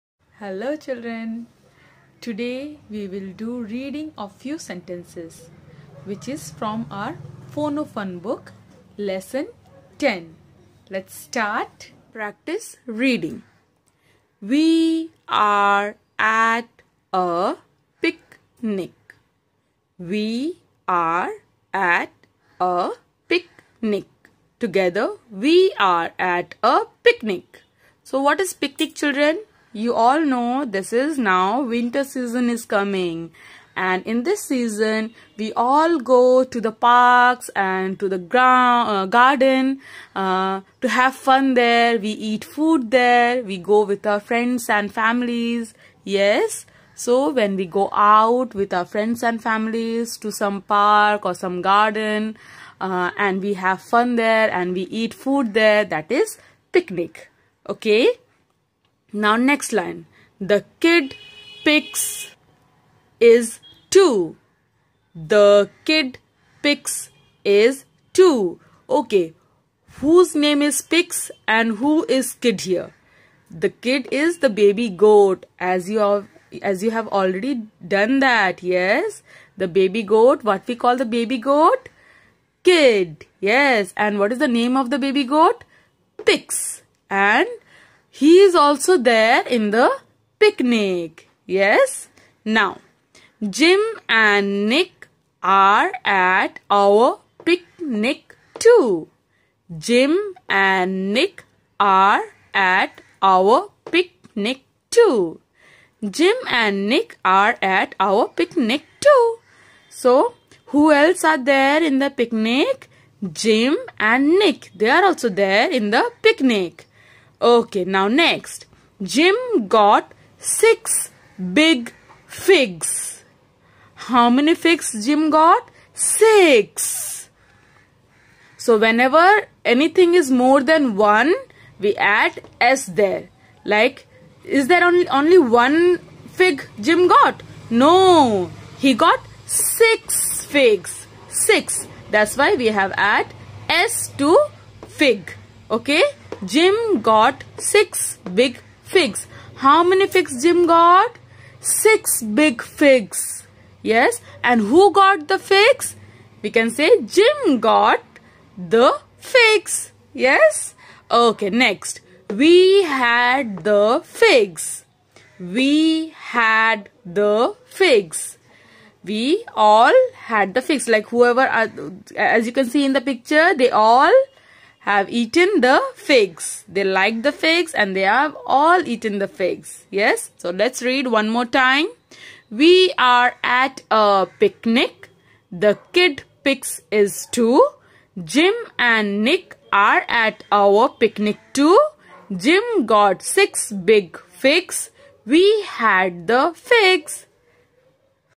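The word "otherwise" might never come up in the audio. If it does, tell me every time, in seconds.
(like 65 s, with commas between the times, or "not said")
not said.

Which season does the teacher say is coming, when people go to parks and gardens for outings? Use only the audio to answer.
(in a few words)
Winter.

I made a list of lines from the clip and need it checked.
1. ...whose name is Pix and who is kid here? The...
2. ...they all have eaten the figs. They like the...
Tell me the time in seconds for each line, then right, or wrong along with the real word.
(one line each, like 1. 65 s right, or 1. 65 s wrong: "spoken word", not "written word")
1. 69 s right
2. 173 s right.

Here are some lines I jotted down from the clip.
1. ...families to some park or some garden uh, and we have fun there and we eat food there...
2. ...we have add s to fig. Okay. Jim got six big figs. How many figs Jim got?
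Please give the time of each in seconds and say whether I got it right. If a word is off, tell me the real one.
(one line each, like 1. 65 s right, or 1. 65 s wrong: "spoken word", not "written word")
1. 49 s right
2. 142 s right.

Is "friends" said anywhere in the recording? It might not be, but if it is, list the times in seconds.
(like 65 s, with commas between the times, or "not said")
44 s, 48 s.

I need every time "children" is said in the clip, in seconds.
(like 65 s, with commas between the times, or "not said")
0 s, 29 s.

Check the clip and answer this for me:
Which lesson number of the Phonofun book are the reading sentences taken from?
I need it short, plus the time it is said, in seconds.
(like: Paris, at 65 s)
10, at 9 s.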